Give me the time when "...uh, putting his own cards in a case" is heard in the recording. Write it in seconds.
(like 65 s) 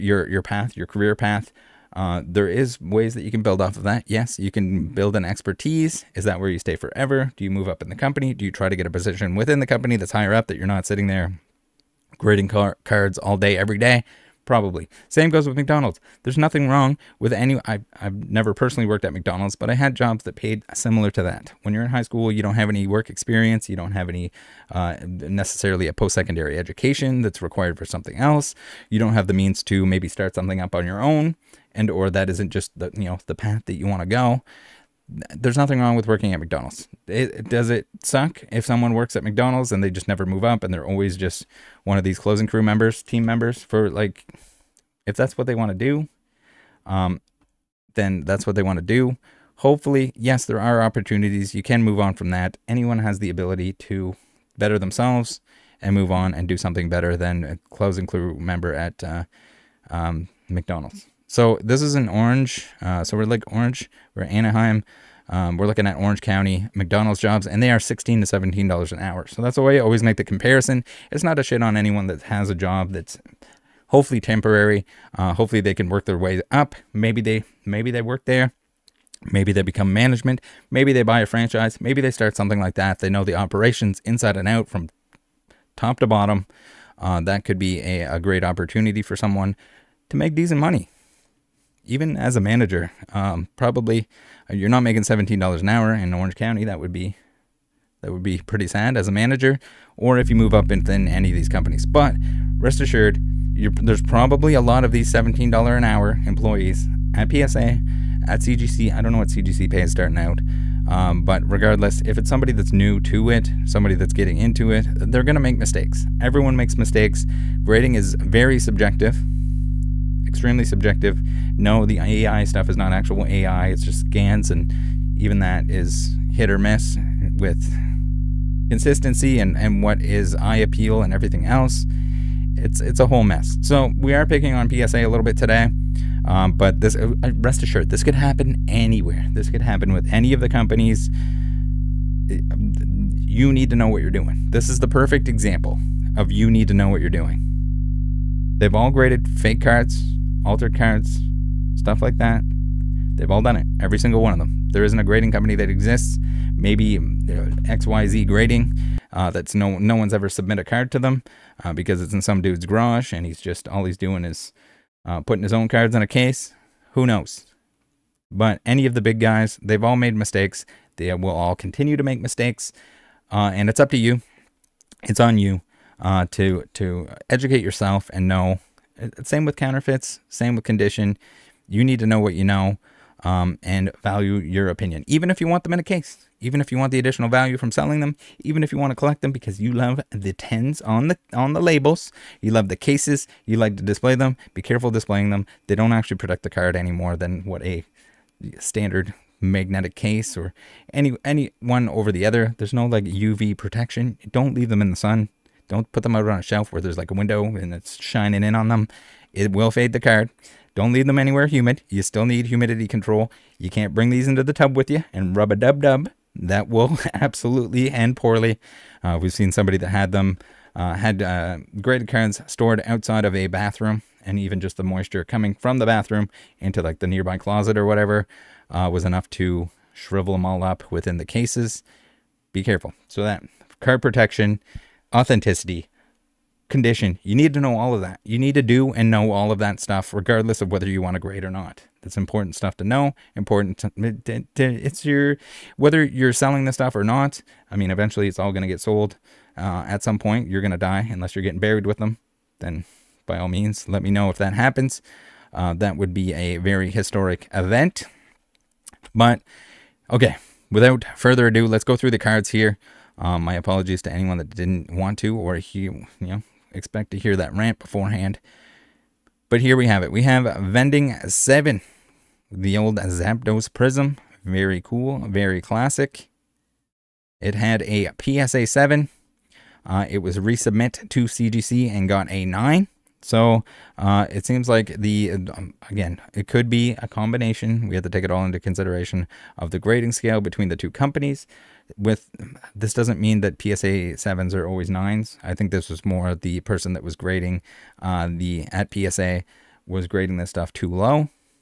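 165 s.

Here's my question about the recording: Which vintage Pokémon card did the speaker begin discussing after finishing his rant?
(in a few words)
Zapdos Prism.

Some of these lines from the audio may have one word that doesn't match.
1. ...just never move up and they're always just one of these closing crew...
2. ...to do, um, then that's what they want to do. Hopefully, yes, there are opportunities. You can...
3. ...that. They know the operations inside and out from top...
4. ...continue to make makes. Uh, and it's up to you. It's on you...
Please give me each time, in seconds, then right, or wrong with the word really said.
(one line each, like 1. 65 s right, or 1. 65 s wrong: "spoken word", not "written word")
1. 39 s right
2. 45 s right
3. 82 s right
4. 171 s wrong: "mistakes", not "makes".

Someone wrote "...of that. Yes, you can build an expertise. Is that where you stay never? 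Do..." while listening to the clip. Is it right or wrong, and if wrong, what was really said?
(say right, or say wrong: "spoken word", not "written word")
wrong: "forever", not "never".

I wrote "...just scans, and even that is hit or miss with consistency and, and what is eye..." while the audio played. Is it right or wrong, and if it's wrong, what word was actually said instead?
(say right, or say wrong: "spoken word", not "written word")
right.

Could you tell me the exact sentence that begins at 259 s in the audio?
But okay, without further ado, let's go through the cards here.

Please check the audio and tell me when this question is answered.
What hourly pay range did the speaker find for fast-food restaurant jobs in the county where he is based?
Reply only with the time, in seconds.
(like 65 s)
67 s.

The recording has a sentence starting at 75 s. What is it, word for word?
Uh, hopefully they can work their way up.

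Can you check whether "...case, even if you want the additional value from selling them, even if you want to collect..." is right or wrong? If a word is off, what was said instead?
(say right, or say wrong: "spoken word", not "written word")
right.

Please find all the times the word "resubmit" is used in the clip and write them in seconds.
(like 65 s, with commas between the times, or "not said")
280 s.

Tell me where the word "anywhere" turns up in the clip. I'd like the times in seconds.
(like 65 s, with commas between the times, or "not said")
138 s, 211 s.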